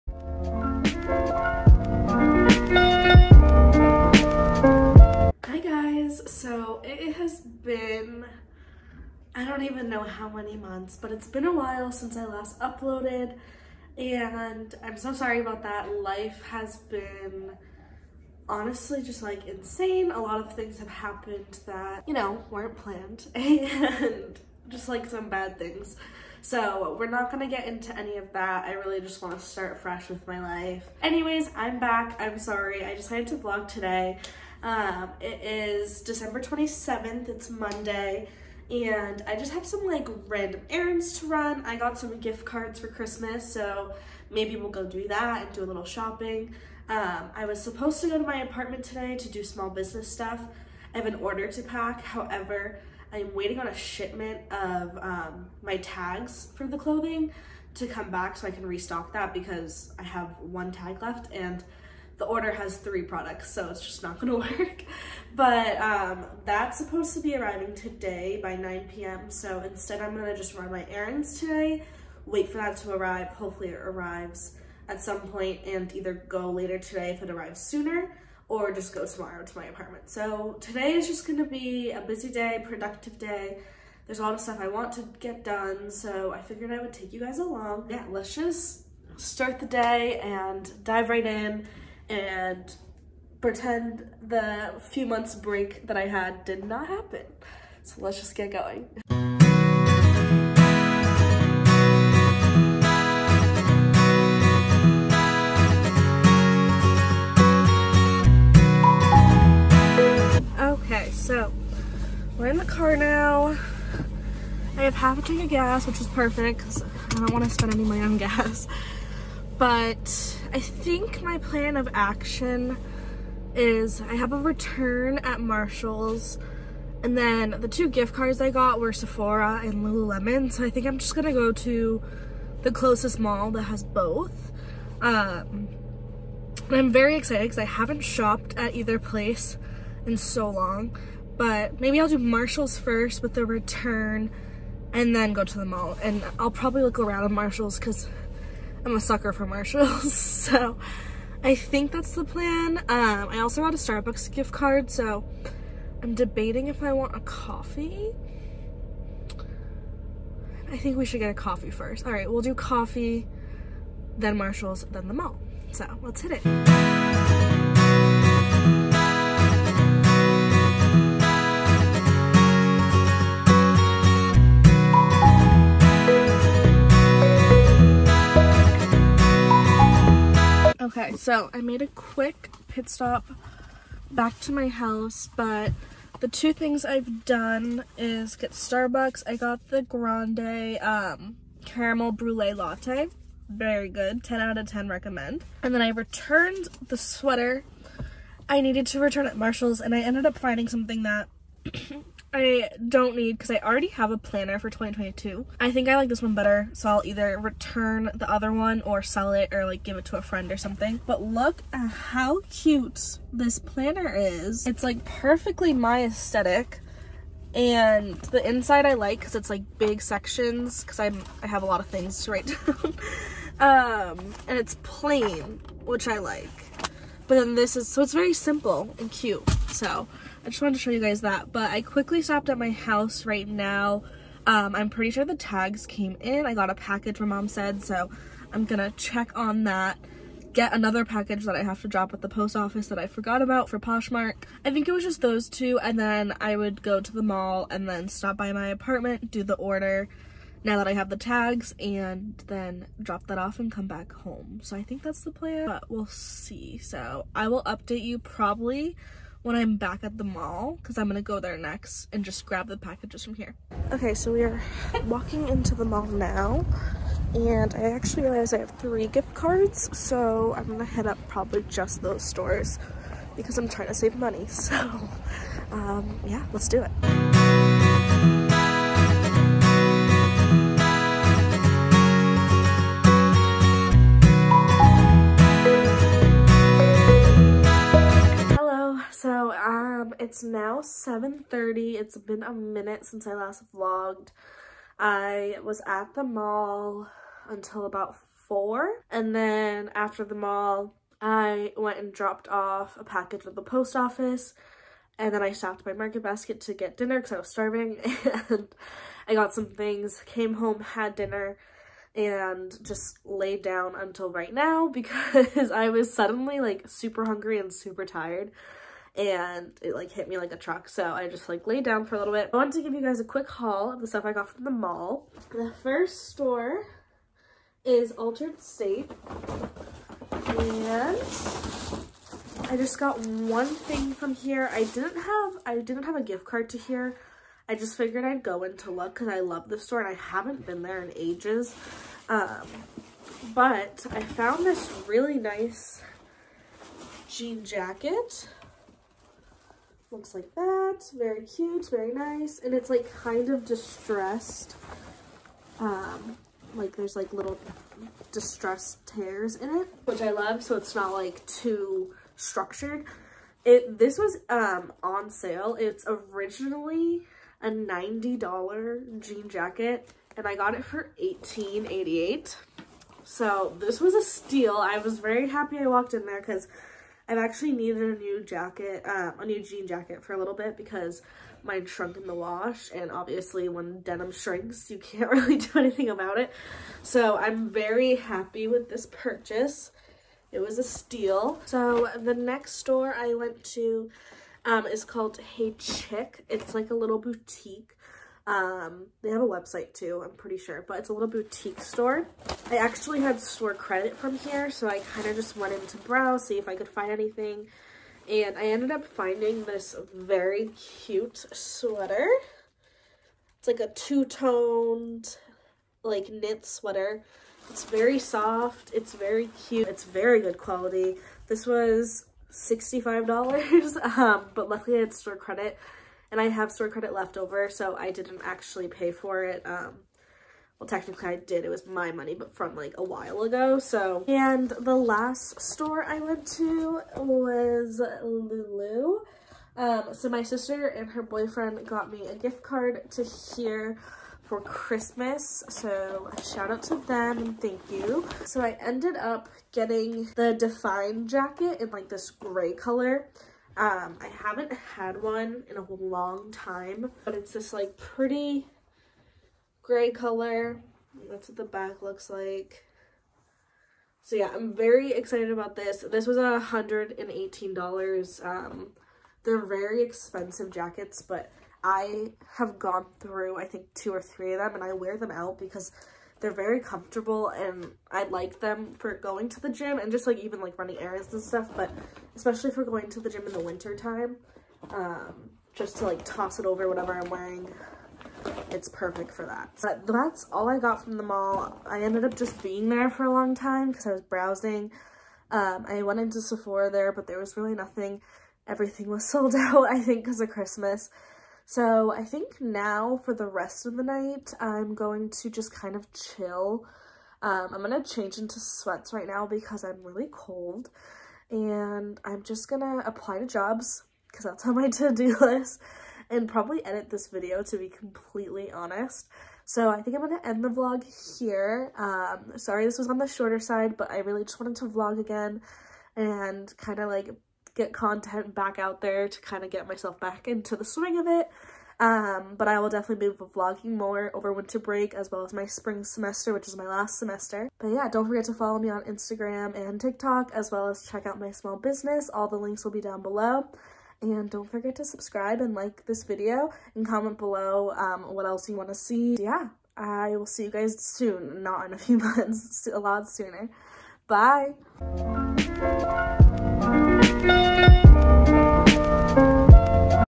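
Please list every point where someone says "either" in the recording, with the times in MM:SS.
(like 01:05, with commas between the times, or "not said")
01:15, 02:18, 03:27.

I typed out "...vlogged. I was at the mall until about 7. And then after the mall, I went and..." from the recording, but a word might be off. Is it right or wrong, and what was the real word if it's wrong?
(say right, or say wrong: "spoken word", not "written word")
wrong: "4", not "7".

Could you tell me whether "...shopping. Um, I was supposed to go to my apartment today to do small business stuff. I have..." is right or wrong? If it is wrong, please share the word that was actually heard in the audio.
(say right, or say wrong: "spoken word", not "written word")
right.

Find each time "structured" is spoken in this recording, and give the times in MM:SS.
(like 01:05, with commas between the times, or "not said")
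06:02.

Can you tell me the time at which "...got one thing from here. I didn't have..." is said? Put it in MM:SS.
05:32.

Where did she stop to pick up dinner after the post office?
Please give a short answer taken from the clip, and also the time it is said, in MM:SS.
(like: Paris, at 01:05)
Market Basket, at 05:05.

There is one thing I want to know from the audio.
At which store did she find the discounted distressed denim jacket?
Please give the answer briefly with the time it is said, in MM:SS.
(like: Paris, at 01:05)
Altar'd State, at 05:28.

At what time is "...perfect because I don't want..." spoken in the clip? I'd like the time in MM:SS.
01:56.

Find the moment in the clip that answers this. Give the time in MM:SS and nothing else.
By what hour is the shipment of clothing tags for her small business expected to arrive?
01:08.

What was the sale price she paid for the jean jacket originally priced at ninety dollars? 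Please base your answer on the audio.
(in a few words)
$18.88.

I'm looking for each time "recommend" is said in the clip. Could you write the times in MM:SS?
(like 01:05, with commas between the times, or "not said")
03:14.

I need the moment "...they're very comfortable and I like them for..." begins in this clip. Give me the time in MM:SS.
07:56.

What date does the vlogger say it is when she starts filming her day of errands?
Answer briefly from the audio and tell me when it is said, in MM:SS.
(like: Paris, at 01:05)
December 27th, at 00:36.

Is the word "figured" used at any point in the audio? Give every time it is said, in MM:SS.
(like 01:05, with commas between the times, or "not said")
01:26, 05:37.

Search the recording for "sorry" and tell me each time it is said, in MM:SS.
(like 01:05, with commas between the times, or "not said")
00:15, 00:32, 08:42.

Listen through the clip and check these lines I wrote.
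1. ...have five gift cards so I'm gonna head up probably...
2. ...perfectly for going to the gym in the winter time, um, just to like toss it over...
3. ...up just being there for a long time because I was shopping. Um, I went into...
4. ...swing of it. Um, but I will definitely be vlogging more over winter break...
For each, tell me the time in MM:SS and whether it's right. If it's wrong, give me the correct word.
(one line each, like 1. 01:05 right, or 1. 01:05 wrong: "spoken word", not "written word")
1. 04:28 wrong: "three", not "five"
2. 08:02 wrong: "especially", not "perfectly"
3. 08:12 wrong: "browsing", not "shopping"
4. 08:50 right.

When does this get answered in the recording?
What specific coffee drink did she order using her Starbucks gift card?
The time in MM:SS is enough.
03:11.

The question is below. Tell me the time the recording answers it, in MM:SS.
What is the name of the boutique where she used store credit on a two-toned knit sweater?
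06:35.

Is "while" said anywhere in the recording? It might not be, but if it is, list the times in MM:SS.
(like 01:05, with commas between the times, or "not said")
00:11, 07:13.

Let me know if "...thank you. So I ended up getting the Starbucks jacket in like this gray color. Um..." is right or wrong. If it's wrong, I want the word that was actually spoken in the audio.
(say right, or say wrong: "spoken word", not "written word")
wrong: "Define", not "Starbucks".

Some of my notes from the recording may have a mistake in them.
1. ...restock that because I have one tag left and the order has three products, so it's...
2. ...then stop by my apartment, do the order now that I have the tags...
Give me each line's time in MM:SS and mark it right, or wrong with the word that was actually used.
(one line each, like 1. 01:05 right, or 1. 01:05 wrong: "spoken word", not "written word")
1. 00:58 right
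2. 04:07 right.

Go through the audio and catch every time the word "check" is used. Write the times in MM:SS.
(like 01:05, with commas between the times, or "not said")
03:58, 09:01.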